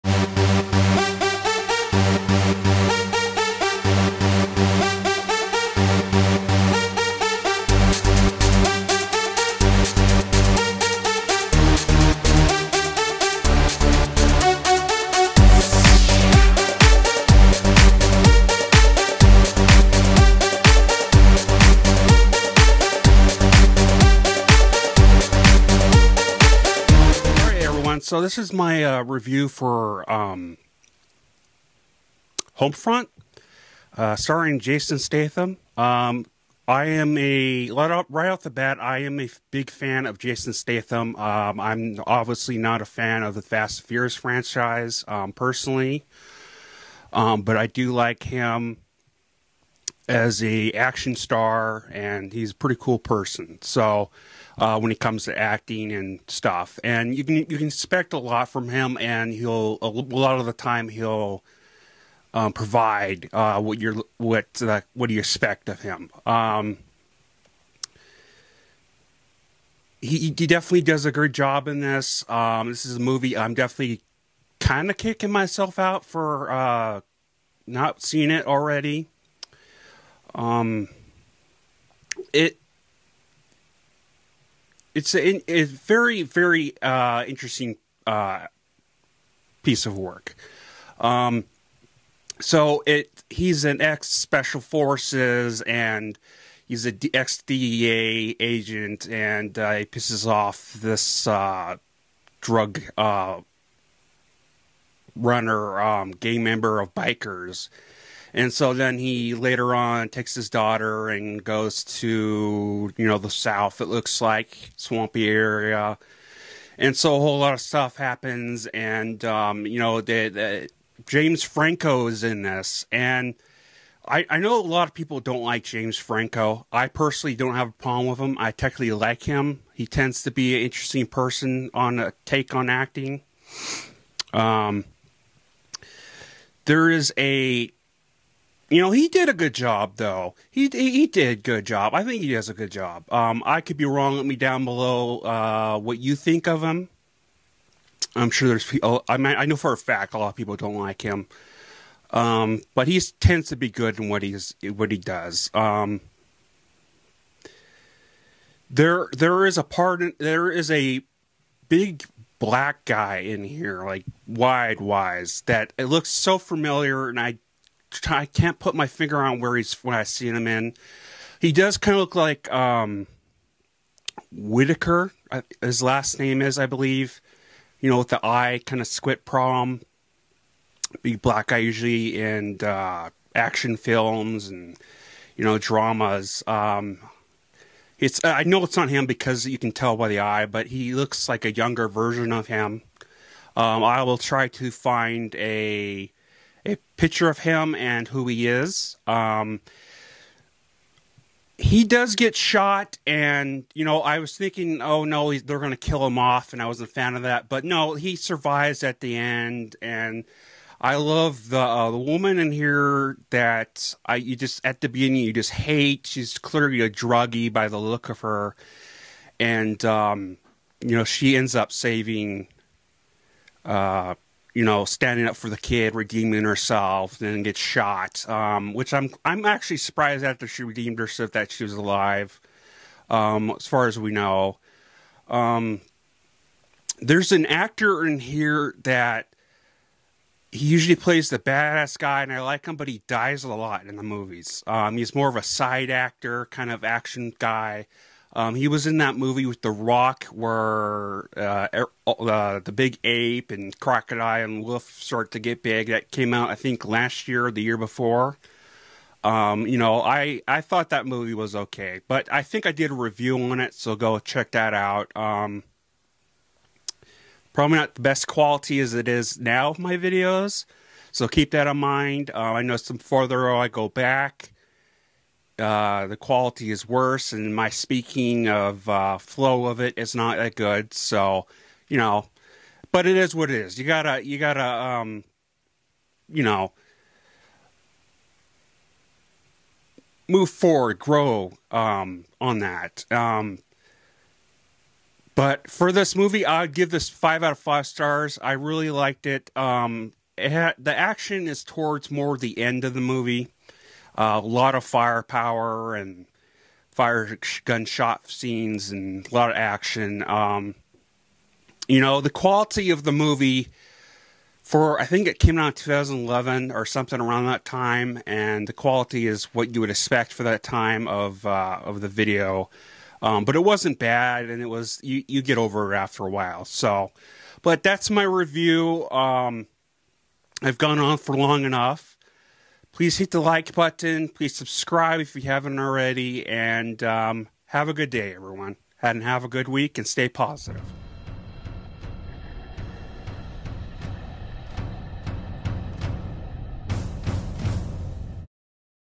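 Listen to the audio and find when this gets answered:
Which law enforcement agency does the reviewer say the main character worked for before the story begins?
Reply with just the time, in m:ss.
1:37.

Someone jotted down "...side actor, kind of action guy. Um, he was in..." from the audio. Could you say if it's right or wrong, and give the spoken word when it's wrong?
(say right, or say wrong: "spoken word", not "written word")
right.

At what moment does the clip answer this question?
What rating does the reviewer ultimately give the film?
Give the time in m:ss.
4:57.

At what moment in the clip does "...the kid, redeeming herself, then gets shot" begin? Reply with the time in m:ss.
3:45.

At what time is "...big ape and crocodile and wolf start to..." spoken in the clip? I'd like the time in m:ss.
4:12.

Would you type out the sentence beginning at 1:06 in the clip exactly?
Um, he, he definitely does a good job in this.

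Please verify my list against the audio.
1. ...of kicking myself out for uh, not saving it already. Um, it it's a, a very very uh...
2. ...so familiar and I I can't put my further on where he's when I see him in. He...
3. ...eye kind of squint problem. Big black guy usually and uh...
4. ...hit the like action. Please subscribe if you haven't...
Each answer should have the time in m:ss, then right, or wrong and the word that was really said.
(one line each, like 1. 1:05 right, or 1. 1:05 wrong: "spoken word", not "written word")
1. 1:14 wrong: "seeing", not "saving"
2. 2:46 wrong: "finger", not "further"
3. 2:58 right
4. 5:33 wrong: "button", not "action".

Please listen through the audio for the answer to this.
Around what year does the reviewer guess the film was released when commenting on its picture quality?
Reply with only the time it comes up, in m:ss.
5:15.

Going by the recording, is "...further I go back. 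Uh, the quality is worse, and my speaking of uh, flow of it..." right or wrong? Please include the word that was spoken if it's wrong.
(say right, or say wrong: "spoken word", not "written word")
right.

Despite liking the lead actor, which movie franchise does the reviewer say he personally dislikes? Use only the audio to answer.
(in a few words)
Fast and Furious.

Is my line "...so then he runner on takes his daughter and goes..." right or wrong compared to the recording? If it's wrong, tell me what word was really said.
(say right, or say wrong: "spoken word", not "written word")
wrong: "later", not "runner".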